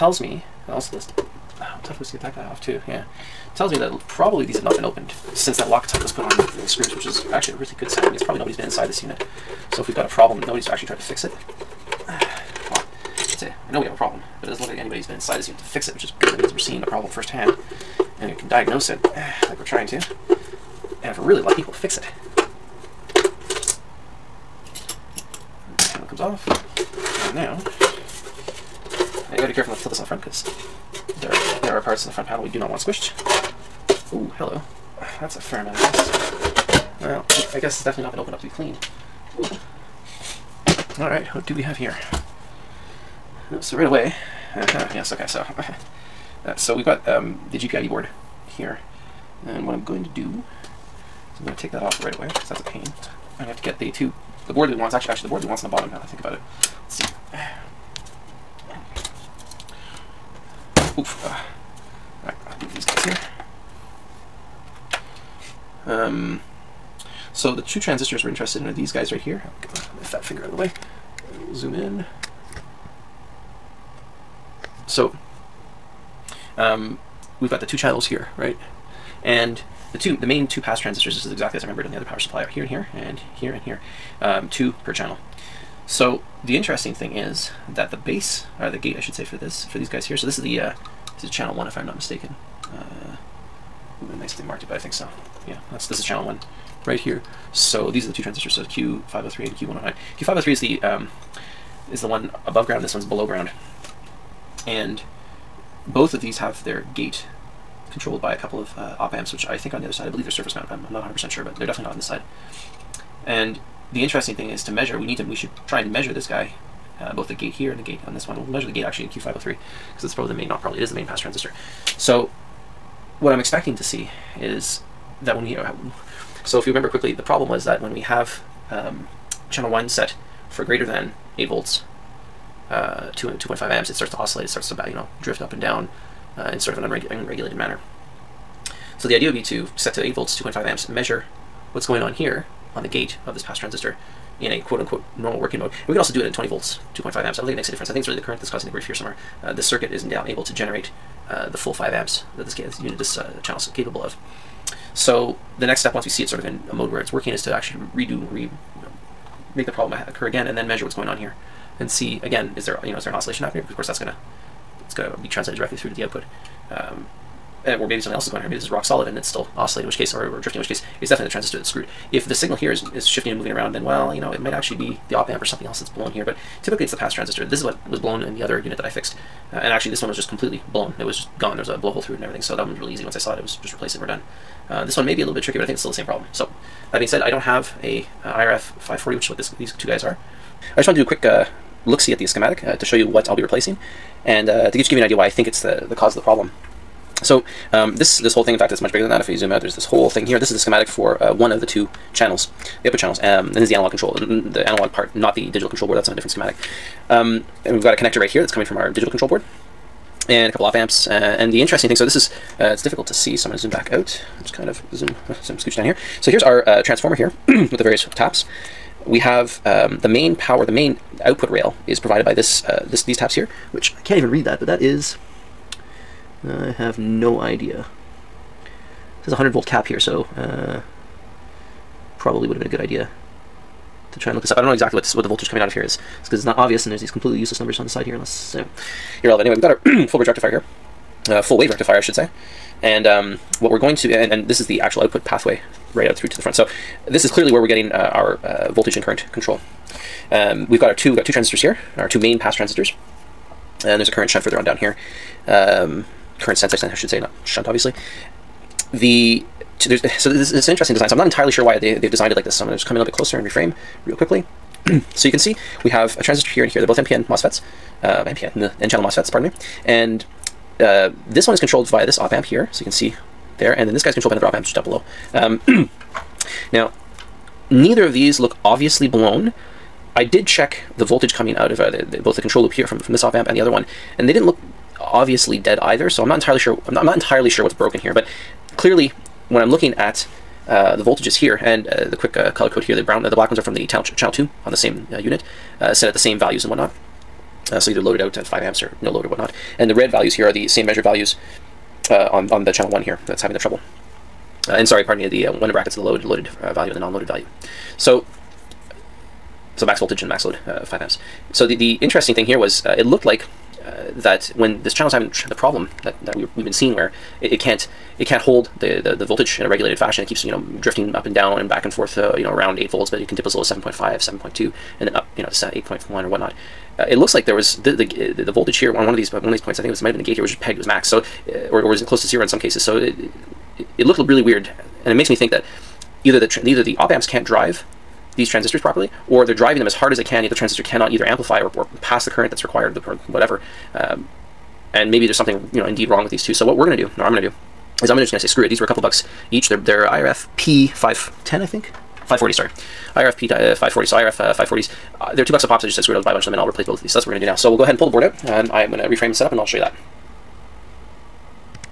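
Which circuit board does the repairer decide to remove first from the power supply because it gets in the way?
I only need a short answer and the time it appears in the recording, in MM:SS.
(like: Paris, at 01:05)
GPIB board, at 00:47.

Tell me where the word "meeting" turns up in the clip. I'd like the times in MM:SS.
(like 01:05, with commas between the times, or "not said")
not said.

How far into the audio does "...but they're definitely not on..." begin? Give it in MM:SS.
01:51.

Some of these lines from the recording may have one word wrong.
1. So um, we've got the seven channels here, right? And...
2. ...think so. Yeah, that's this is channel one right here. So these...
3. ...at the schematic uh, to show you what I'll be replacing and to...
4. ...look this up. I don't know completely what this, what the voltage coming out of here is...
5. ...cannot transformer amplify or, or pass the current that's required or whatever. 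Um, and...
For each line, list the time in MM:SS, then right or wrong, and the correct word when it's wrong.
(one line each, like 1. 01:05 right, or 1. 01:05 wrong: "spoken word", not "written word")
1. 01:14 wrong: "two", not "seven"
2. 01:34 right
3. 03:12 right
4. 03:54 wrong: "exactly", not "completely"
5. 05:40 wrong: "either", not "transformer".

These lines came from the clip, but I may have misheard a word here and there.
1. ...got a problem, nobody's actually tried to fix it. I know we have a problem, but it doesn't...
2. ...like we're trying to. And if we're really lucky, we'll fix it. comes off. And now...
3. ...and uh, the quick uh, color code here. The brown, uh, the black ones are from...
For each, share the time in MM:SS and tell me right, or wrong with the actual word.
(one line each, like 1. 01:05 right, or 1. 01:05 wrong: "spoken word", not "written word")
1. 00:09 right
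2. 00:19 right
3. 04:51 right.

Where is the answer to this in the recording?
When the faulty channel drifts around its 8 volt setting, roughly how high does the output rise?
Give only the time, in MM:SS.
05:25.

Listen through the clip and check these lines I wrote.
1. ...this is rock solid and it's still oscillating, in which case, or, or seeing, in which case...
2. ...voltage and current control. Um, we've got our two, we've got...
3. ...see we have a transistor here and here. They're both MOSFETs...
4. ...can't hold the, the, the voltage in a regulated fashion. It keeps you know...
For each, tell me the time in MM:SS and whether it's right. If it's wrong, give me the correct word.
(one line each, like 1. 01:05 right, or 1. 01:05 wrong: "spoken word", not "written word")
1. 02:48 wrong: "drifting", not "seeing"
2. 04:08 right
3. 04:25 wrong: "NPN", not "MOSFETs"
4. 05:18 right.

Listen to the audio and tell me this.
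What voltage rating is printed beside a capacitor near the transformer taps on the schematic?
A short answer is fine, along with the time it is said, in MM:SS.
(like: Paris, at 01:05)
100 volts, at 03:49.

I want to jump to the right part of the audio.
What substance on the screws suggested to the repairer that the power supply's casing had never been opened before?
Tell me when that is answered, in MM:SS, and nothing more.
00:05.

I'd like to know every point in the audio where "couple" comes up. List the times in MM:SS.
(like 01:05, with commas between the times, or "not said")
01:48, 03:30, 05:48.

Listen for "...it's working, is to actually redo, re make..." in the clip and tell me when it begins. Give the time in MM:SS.
02:36.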